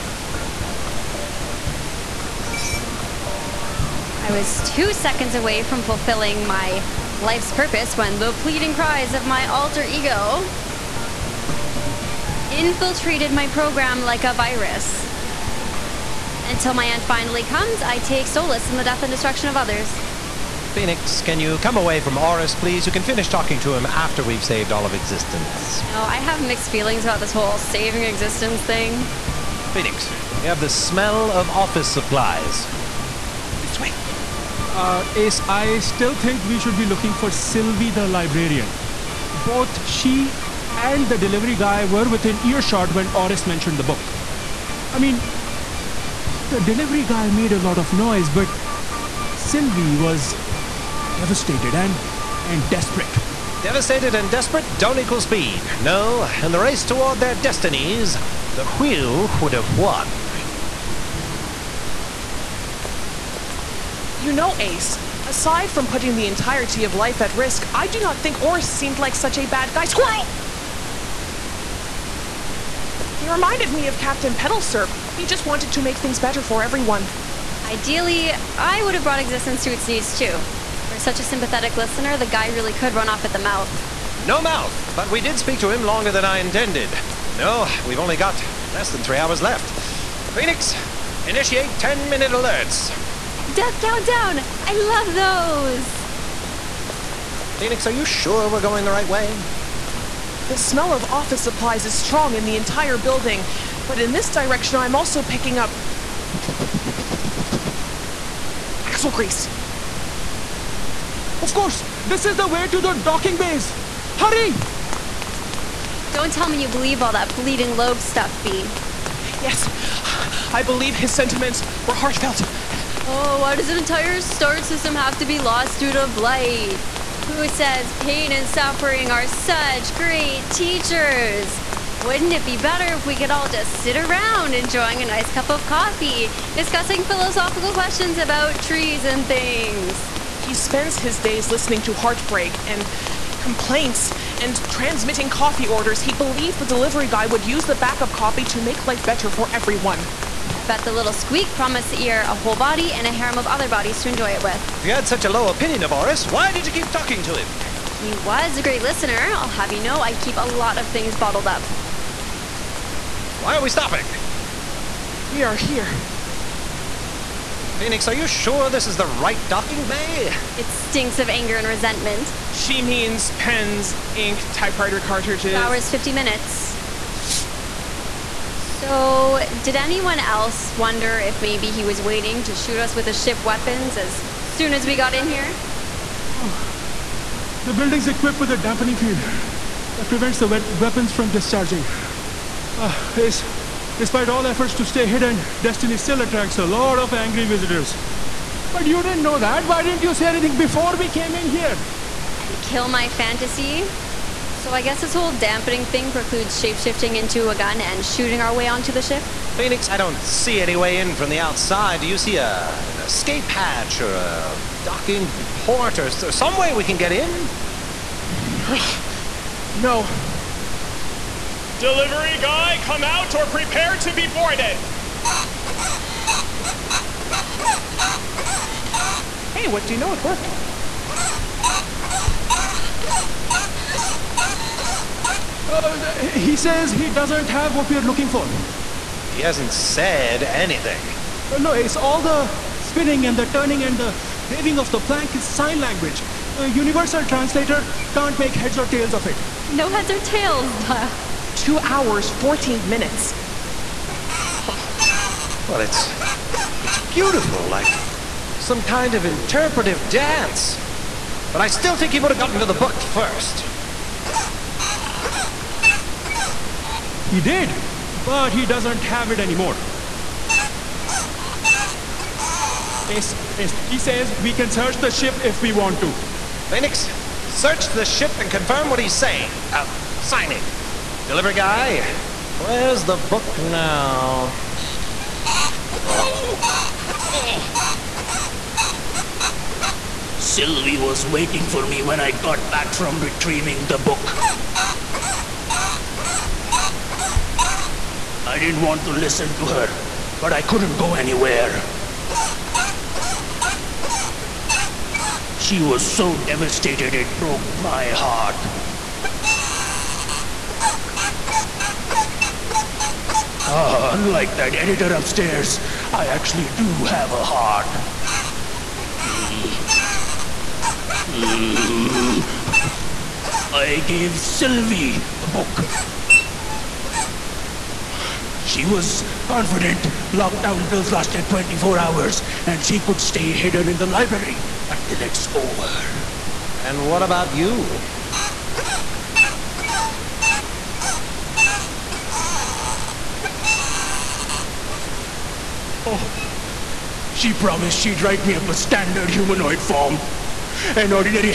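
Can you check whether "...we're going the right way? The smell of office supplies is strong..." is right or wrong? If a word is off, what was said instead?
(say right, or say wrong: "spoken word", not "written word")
right.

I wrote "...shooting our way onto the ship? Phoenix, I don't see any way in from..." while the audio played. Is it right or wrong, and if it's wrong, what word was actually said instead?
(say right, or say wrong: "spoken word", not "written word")
right.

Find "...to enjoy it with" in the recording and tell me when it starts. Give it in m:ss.
2:34.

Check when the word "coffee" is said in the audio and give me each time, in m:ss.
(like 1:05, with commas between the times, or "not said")
2:15, 2:25.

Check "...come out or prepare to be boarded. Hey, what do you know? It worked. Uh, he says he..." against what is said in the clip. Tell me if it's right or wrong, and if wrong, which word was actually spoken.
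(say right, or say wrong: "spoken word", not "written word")
right.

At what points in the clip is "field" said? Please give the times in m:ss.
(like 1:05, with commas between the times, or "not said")
3:08.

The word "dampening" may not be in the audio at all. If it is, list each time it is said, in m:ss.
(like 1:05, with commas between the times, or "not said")
3:08, 3:25.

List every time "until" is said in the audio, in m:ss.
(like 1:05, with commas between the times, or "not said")
0:16, 5:34.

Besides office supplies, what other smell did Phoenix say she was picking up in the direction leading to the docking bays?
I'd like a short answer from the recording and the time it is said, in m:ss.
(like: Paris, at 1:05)
axle grease, at 1:48.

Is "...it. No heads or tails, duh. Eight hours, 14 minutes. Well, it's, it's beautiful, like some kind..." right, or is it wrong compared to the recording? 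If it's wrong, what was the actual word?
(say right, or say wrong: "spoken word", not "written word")
wrong: "Two", not "Eight".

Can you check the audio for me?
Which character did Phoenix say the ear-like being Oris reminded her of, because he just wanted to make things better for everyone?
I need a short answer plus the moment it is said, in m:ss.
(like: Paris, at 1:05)
Captain Petalsurp, at 1:13.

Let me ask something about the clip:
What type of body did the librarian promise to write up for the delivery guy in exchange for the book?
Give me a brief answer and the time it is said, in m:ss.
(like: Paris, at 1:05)
standard humanoid form, at 5:48.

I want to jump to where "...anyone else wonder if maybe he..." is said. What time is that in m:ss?
2:59.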